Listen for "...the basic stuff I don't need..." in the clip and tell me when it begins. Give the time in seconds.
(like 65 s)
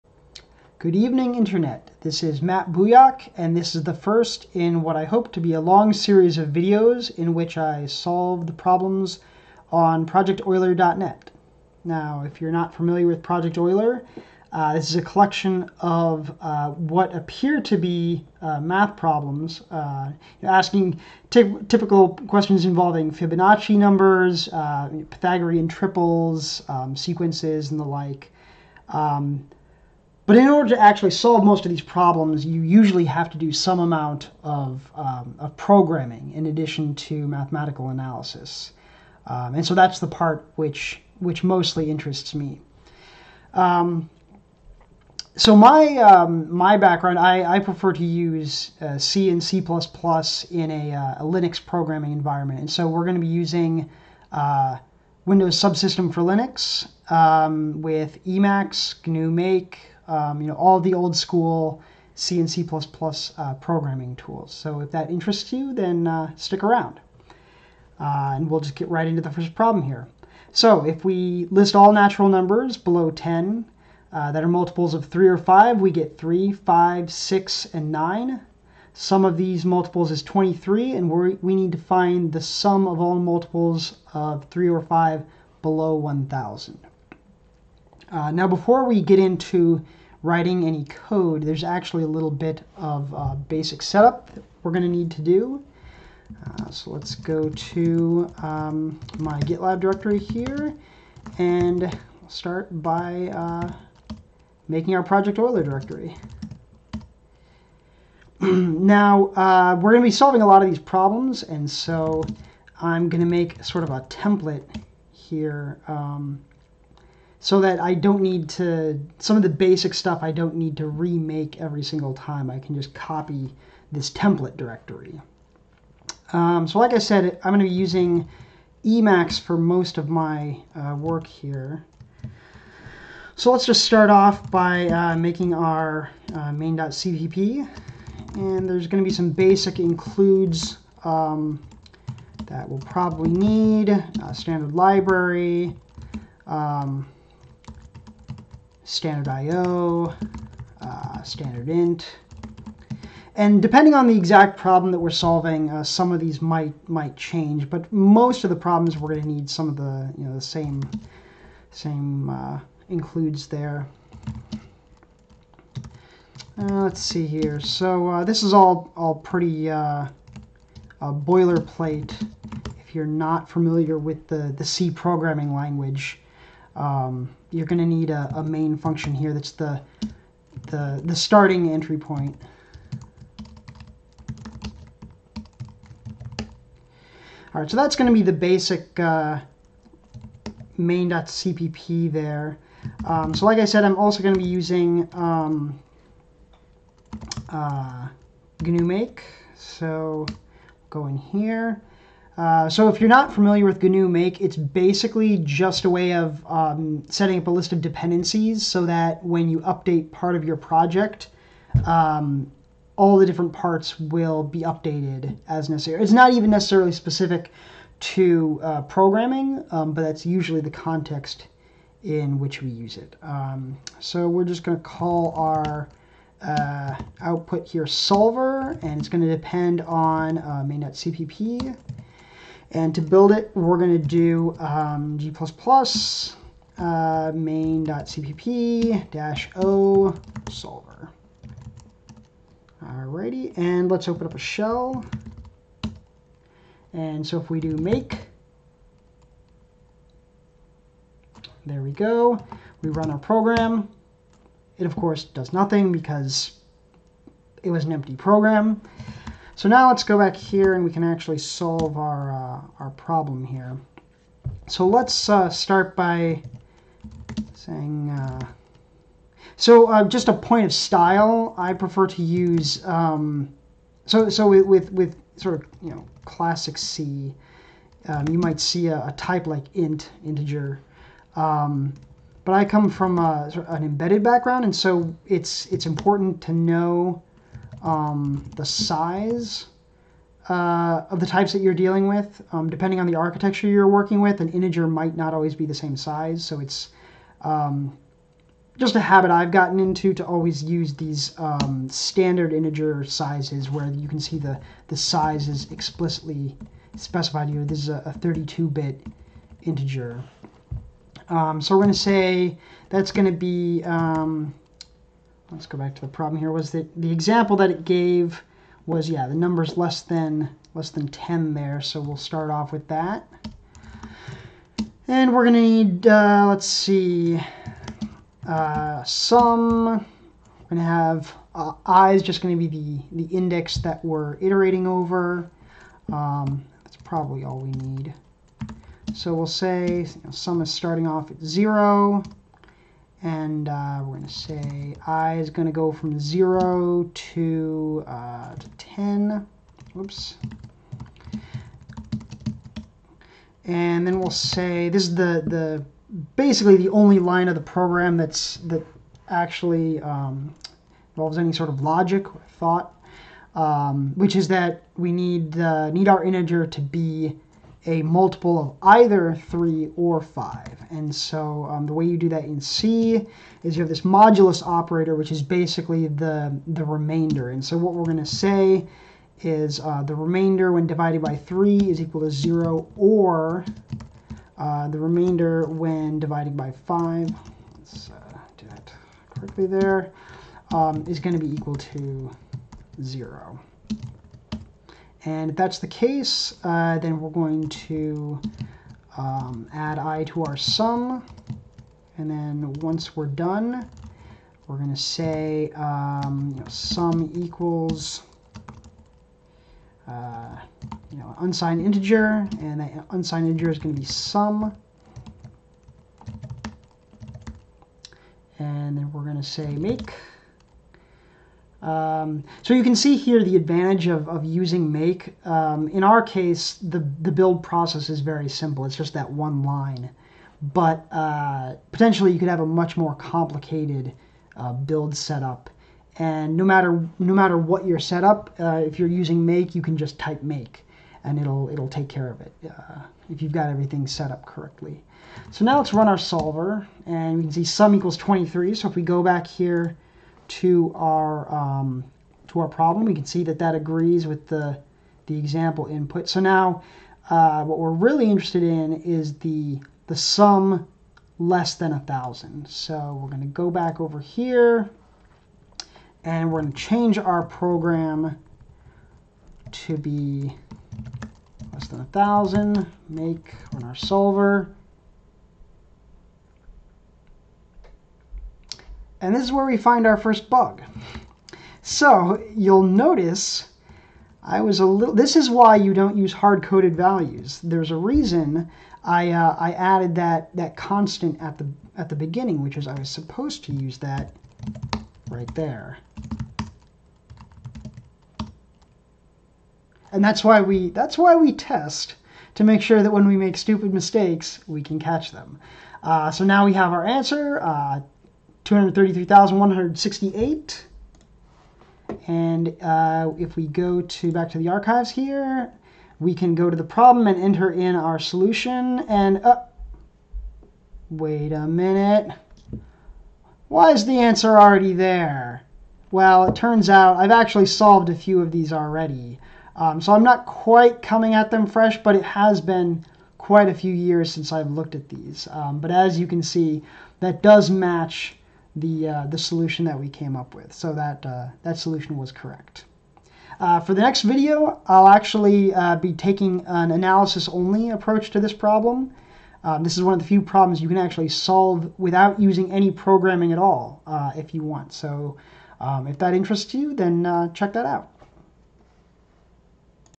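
119 s.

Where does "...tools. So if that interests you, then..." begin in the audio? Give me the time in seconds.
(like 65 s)
64 s.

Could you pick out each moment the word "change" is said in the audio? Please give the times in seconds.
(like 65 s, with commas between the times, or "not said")
157 s, 466 s.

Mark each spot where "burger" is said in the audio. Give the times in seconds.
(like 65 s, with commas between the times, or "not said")
not said.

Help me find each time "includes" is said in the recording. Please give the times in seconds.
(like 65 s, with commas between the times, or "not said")
139 s, 162 s.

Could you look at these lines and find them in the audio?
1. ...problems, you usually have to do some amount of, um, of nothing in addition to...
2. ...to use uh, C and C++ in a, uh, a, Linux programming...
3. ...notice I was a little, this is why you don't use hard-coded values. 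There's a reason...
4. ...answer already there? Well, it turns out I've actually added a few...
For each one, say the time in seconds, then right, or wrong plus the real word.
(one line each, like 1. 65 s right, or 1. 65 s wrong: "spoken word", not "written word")
1. 31 s wrong: "programming", not "nothing"
2. 47 s right
3. 482 s right
4. 524 s wrong: "solved", not "added".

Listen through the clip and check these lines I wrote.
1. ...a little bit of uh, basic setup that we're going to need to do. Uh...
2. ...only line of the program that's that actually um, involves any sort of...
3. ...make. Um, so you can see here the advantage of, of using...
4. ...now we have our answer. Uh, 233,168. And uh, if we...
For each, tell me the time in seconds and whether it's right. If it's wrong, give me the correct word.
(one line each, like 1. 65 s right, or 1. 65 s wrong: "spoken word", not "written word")
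1. 92 s right
2. 356 s right
3. 419 s right
4. 506 s right.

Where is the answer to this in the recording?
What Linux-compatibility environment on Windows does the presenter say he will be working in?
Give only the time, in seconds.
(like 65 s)
55 s.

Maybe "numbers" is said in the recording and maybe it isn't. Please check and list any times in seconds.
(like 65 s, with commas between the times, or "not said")
23 s, 72 s, 319 s.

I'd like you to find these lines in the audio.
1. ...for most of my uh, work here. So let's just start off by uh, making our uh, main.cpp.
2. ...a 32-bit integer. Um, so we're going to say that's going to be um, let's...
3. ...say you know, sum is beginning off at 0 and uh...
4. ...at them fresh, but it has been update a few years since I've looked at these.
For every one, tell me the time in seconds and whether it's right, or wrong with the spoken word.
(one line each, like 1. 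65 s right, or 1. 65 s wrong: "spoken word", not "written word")
1. 129 s right
2. 307 s right
3. 339 s wrong: "starting", not "beginning"
4. 531 s wrong: "quite", not "update".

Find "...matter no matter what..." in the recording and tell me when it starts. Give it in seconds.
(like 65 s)
436 s.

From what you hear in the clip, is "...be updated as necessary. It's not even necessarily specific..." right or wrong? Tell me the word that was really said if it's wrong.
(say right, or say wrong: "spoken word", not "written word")
right.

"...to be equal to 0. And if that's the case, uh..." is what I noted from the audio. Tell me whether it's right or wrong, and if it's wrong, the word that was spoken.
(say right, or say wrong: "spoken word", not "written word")
right.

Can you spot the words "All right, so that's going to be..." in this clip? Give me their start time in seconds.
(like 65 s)
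187 s.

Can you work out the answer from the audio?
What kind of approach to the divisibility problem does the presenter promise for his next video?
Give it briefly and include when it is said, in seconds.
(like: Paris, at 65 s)
analysis-only, at 546 s.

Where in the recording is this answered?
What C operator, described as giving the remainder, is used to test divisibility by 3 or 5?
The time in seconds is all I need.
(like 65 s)
374 s.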